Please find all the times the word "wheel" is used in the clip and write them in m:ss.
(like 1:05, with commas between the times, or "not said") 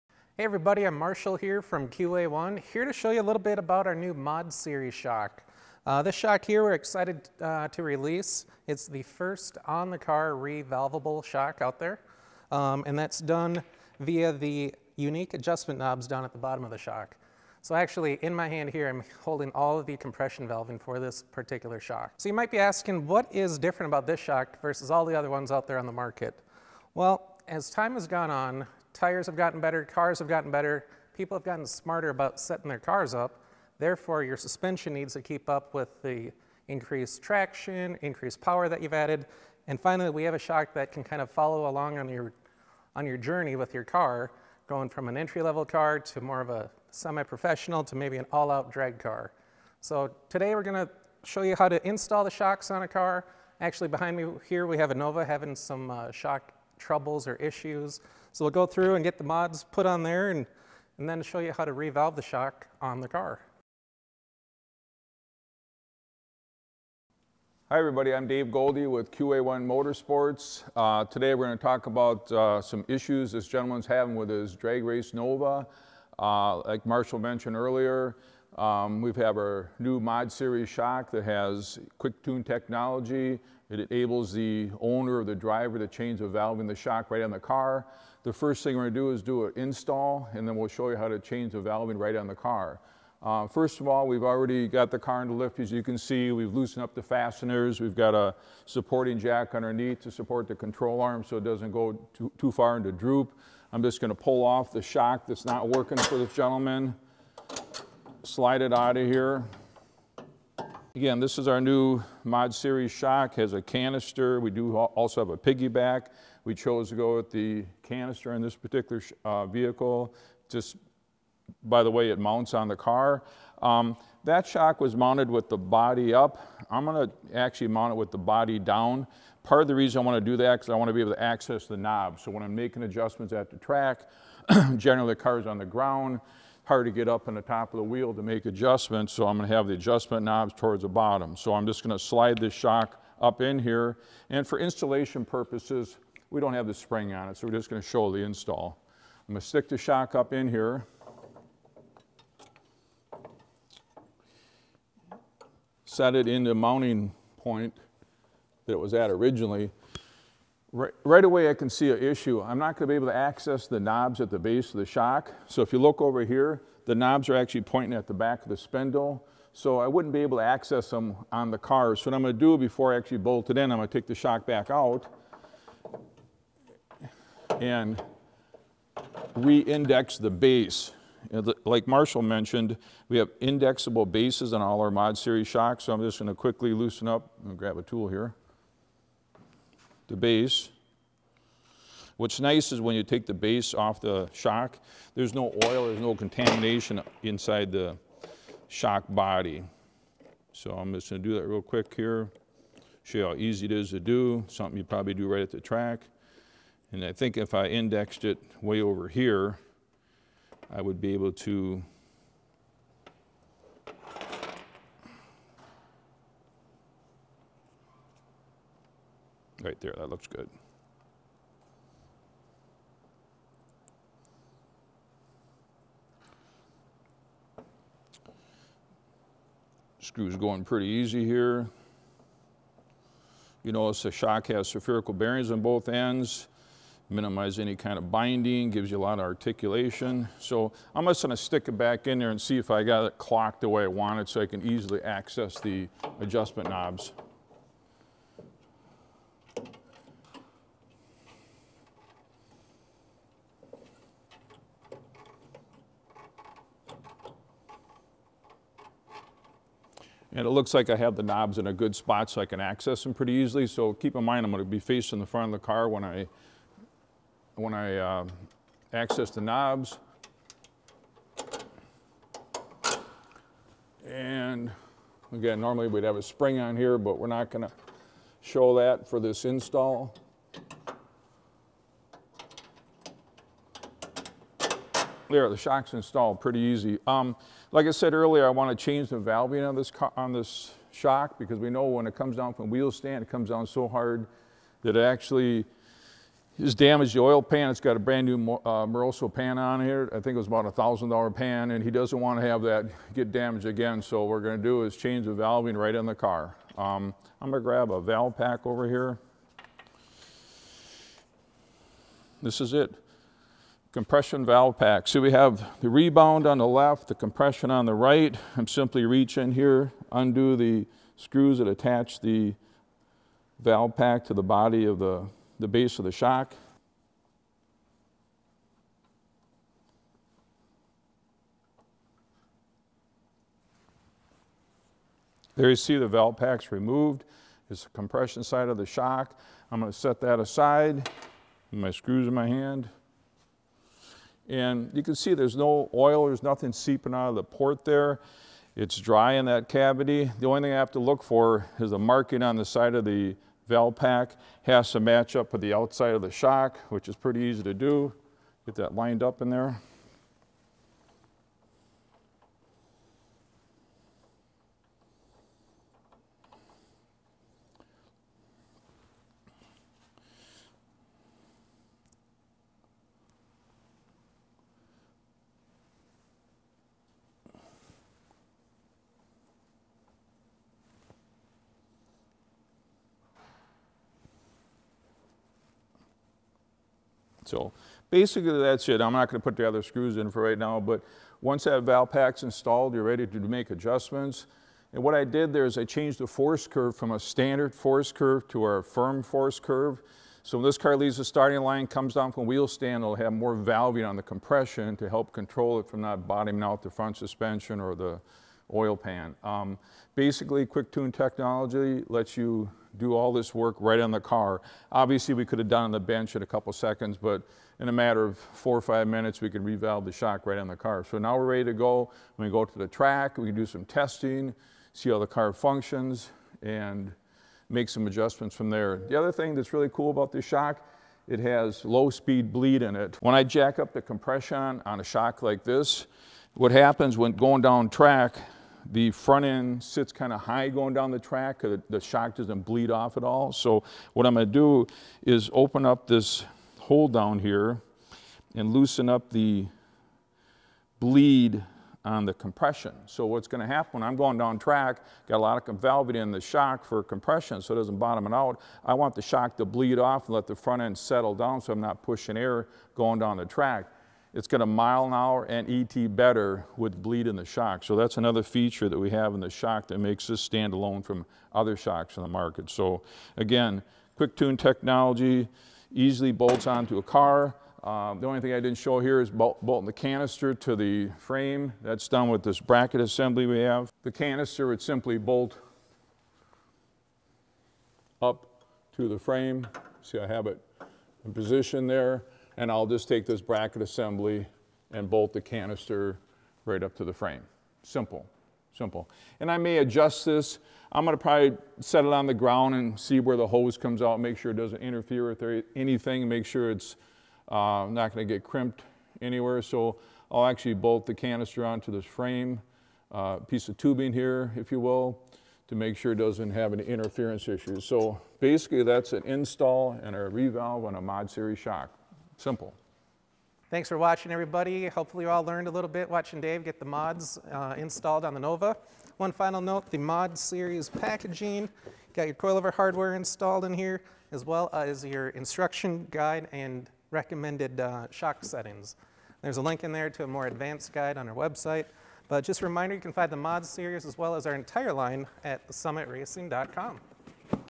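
2:17, 4:52, 6:42.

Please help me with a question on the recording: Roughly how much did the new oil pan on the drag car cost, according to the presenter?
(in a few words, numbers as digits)
$1,000.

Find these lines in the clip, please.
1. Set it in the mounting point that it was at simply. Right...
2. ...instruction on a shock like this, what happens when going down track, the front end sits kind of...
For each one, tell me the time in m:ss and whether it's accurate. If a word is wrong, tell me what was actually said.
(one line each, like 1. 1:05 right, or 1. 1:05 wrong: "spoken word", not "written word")
1. 2:35 wrong: "originally", not "simply"
2. 7:14 wrong: "compression", not "instruction".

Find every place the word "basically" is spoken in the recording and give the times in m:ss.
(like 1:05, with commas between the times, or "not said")
6:28, 6:50, 8:38.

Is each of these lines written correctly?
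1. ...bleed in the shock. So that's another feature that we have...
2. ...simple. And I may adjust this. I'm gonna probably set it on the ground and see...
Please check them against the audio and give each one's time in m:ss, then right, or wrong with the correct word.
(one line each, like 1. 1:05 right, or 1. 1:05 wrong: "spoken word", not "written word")
1. 7:47 right
2. 8:18 right.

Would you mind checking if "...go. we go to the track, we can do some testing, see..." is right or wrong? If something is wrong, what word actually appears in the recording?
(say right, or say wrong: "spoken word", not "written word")
right.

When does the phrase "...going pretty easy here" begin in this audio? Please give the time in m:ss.
3:50.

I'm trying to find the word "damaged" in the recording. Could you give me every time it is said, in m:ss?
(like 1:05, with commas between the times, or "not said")
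4:56, 5:03.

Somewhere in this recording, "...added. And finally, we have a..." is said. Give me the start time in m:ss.
0:38.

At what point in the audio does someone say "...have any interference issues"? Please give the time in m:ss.
8:36.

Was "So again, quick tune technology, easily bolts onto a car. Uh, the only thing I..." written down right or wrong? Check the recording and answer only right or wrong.
right.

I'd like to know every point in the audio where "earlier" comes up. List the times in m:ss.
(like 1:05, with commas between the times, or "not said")
1:17, 4:48.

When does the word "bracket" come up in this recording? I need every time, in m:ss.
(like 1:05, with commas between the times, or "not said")
8:02, 8:13.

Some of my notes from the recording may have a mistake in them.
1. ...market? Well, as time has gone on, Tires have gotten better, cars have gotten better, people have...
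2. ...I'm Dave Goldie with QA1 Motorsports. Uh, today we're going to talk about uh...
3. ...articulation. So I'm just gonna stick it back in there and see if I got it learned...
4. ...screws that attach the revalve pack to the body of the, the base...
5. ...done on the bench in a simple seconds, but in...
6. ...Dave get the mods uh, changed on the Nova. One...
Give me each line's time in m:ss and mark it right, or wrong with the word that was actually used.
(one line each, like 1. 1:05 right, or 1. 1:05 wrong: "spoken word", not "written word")
1. 0:25 right
2. 1:08 right
3. 3:59 wrong: "clocked", not "learned"
4. 5:21 wrong: "valve", not "revalve"
5. 6:55 wrong: "couple", not "simple"
6. 8:46 wrong: "installed", not "changed".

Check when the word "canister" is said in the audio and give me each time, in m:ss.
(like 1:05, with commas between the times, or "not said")
1:53, 1:57, 7:59, 8:04, 8:15, 8:31.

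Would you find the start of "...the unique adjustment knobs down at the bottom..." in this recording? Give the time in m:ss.
0:14.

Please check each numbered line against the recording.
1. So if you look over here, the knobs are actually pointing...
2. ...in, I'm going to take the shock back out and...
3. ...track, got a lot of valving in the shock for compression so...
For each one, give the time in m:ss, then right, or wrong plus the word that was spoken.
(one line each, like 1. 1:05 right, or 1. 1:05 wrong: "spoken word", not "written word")
1. 2:45 right
2. 2:53 right
3. 7:34 right.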